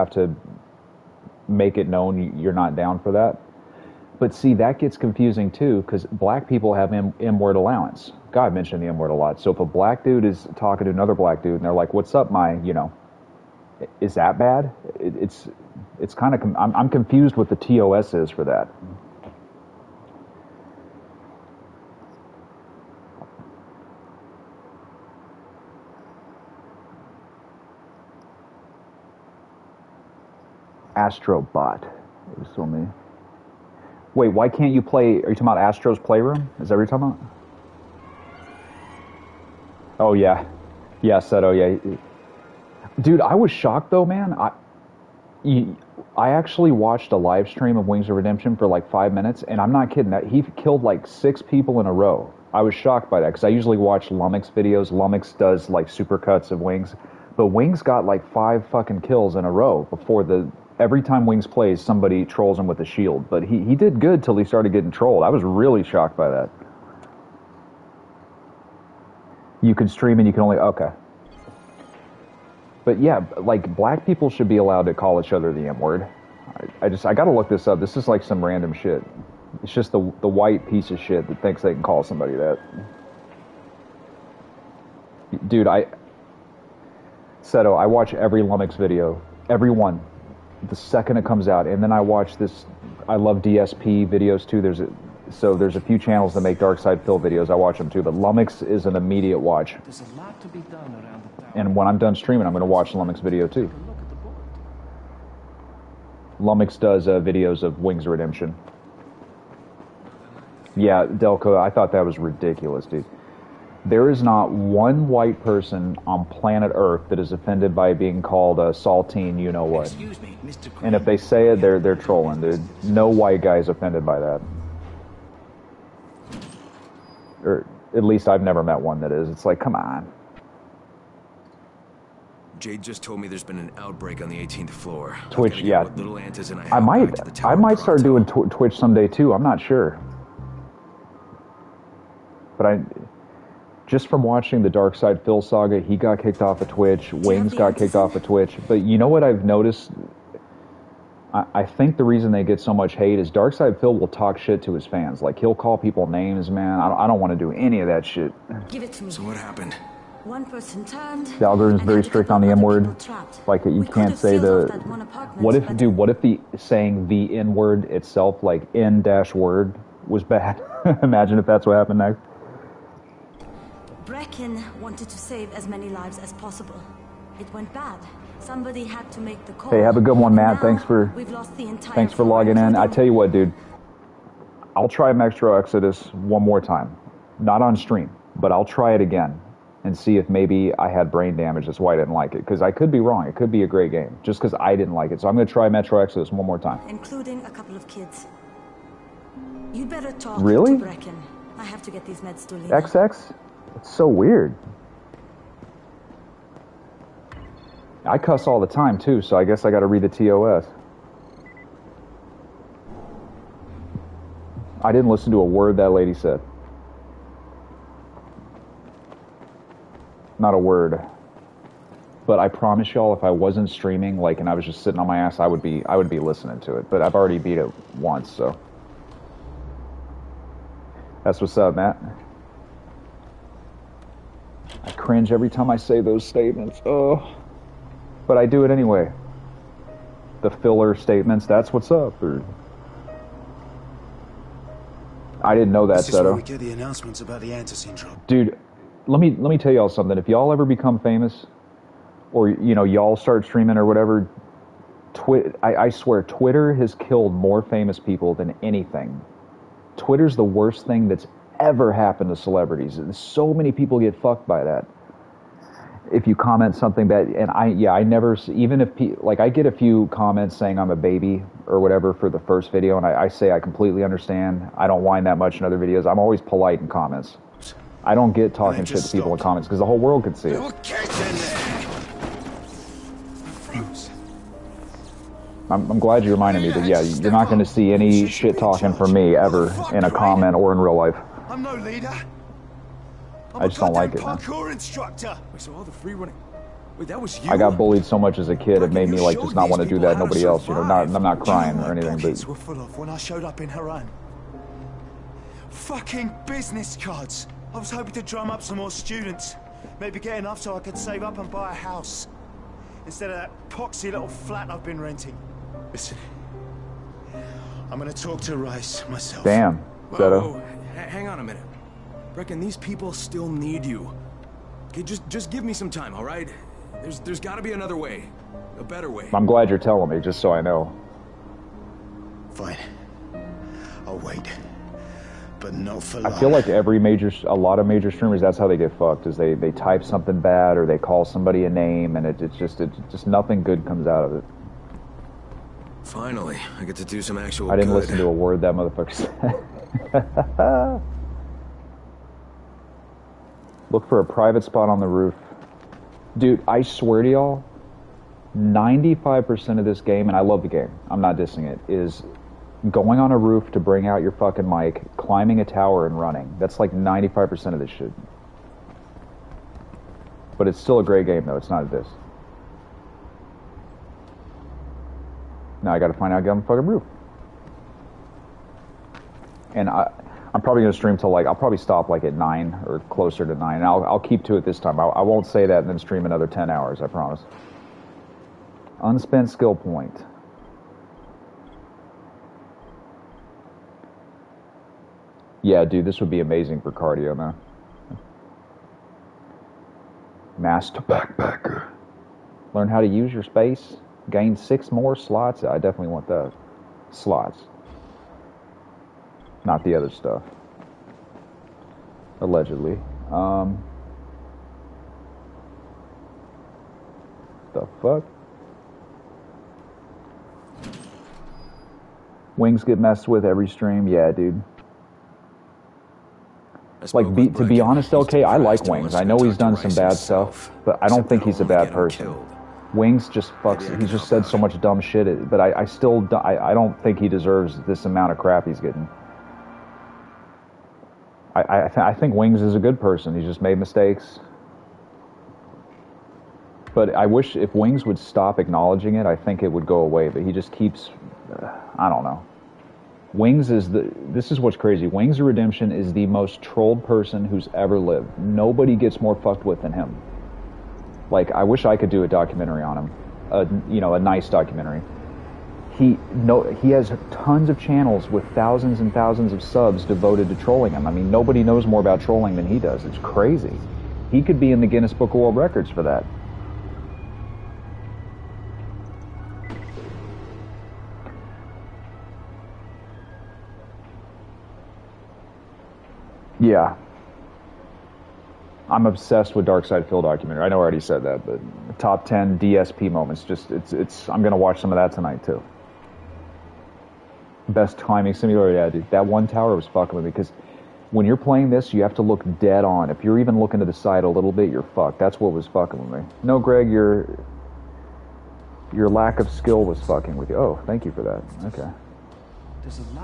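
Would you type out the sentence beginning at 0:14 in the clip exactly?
It, it's it's kind of com- I'm, I'm confused what the TOS is for that.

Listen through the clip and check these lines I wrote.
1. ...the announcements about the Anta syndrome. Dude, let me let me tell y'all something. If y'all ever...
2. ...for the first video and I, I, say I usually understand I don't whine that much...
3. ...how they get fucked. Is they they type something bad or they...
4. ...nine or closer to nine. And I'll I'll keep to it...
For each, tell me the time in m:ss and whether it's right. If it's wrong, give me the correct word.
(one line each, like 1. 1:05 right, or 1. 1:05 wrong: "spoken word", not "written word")
1. 4:06 right
2. 4:32 wrong: "completely", not "usually"
3. 5:38 right
4. 6:22 right.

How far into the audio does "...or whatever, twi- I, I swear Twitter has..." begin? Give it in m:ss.
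4:13.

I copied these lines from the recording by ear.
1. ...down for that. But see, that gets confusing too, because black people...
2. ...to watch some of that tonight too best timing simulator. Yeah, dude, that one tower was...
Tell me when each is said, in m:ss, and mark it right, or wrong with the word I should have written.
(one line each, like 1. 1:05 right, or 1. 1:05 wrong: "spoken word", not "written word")
1. 0:02 right
2. 8:14 right.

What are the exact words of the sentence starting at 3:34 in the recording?
I didn't listen to a word that lady said.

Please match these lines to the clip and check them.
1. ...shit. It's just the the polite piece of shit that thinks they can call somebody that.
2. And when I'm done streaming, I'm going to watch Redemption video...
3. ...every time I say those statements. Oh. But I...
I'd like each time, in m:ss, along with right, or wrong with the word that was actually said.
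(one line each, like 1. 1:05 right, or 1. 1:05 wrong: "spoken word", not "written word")
1. 1:18 wrong: "white", not "polite"
2. 1:41 wrong: "Lumix", not "Redemption"
3. 3:55 right.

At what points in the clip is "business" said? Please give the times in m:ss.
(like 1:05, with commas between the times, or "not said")
5:06.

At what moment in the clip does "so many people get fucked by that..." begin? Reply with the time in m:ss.
4:23.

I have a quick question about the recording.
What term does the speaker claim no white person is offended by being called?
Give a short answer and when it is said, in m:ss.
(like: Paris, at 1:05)
saltine, at 1:58.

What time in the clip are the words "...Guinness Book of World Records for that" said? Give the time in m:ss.
7:54.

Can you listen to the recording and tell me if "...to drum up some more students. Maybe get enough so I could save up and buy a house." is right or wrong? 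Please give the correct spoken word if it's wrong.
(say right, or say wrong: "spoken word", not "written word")
right.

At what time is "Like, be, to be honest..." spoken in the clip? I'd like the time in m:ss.
7:07.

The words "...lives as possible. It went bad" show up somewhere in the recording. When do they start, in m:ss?
2:55.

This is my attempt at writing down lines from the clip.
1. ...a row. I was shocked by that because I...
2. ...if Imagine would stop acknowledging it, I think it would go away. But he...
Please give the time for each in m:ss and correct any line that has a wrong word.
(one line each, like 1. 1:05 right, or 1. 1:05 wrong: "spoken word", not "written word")
1. 0:51 right
2. 7:27 wrong: "Wings", not "Imagine".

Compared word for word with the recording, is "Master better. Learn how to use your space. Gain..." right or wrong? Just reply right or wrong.
wrong.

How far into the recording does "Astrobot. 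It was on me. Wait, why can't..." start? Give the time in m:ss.
0:30.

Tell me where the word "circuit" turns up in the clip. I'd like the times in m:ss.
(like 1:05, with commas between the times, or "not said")
not said.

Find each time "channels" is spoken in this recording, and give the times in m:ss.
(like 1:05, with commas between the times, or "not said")
1:35, 7:47.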